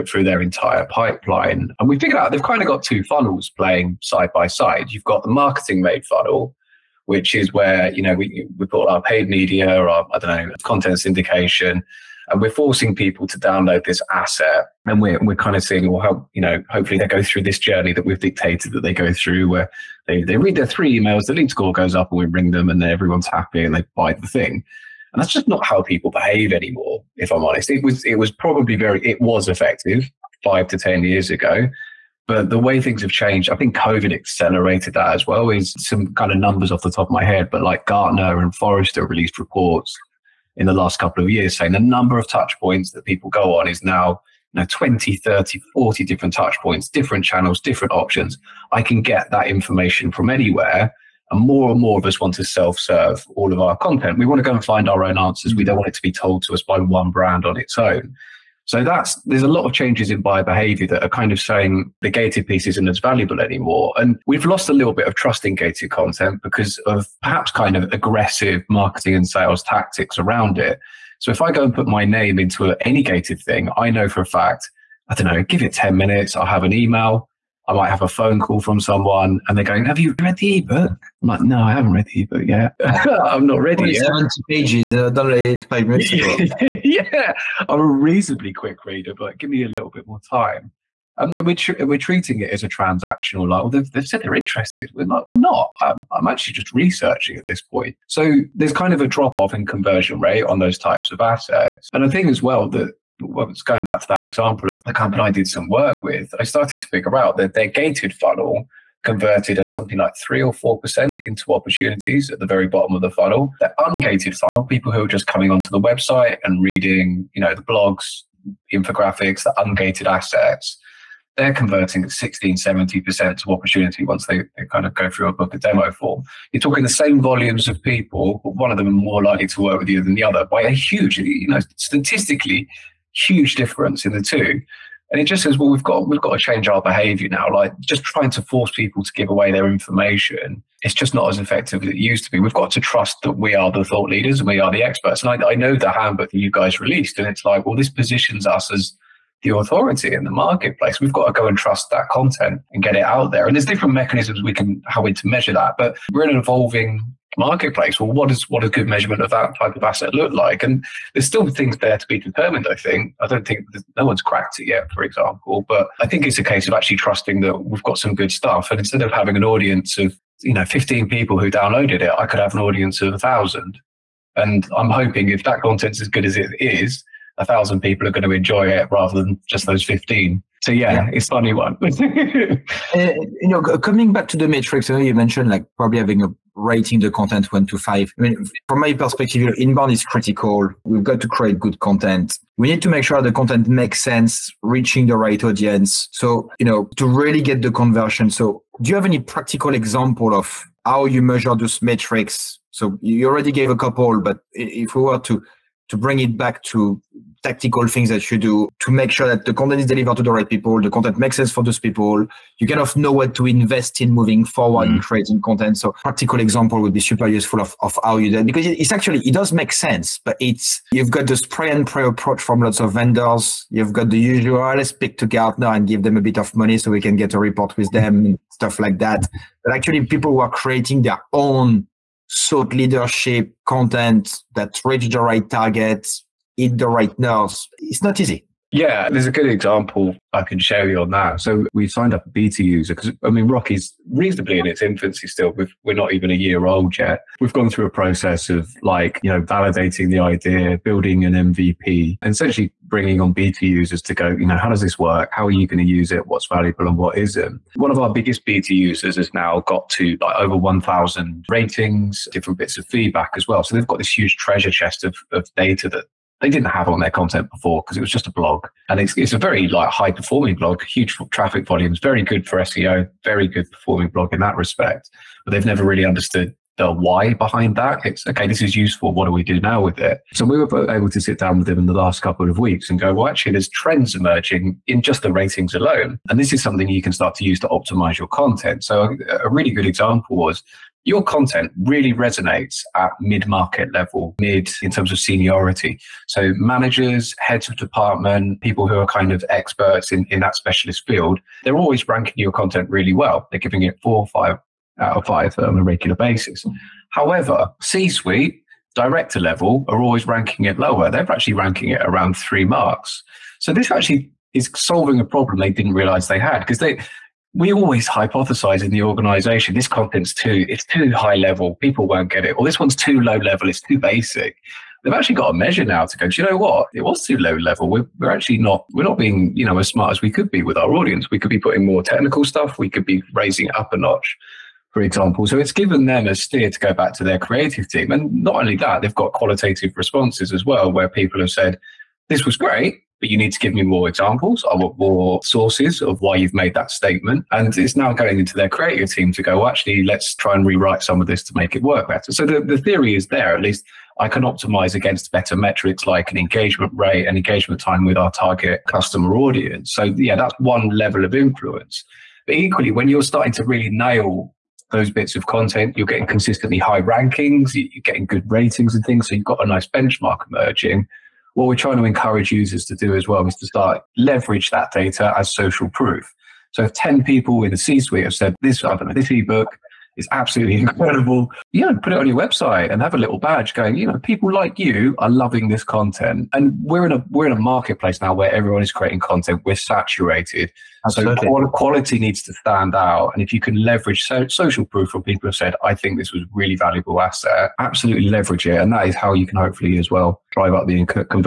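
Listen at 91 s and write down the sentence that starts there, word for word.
Um, we're, tr- we're treating it as a transactional.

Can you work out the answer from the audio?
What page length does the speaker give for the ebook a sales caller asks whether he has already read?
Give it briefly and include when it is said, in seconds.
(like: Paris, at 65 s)
70 pages, at 84 s.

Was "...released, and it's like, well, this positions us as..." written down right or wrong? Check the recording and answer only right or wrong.
right.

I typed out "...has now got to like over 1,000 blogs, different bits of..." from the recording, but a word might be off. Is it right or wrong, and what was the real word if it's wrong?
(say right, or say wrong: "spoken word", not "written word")
wrong: "ratings", not "blogs".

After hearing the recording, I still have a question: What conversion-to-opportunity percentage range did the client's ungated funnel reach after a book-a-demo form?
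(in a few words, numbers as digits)
60-70%.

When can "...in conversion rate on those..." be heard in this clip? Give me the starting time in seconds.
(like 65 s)
99 s.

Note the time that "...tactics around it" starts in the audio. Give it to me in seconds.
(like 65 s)
69 s.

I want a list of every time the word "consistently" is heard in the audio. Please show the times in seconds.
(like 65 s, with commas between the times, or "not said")
366 s.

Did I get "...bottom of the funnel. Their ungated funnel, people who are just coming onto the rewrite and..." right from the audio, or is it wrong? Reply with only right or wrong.
wrong.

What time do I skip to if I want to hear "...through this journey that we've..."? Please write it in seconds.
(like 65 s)
17 s.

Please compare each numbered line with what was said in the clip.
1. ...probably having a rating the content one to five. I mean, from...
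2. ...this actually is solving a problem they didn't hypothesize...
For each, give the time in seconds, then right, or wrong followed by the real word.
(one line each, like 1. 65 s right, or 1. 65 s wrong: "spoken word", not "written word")
1. 185 s right
2. 313 s wrong: "realize", not "hypothesize".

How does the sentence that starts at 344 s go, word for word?
I want more sources of why you've made that statement.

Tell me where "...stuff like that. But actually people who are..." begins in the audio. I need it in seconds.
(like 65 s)
228 s.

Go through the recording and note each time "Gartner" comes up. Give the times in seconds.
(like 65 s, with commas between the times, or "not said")
37 s, 225 s.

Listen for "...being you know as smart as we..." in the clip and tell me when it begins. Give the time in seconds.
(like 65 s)
329 s.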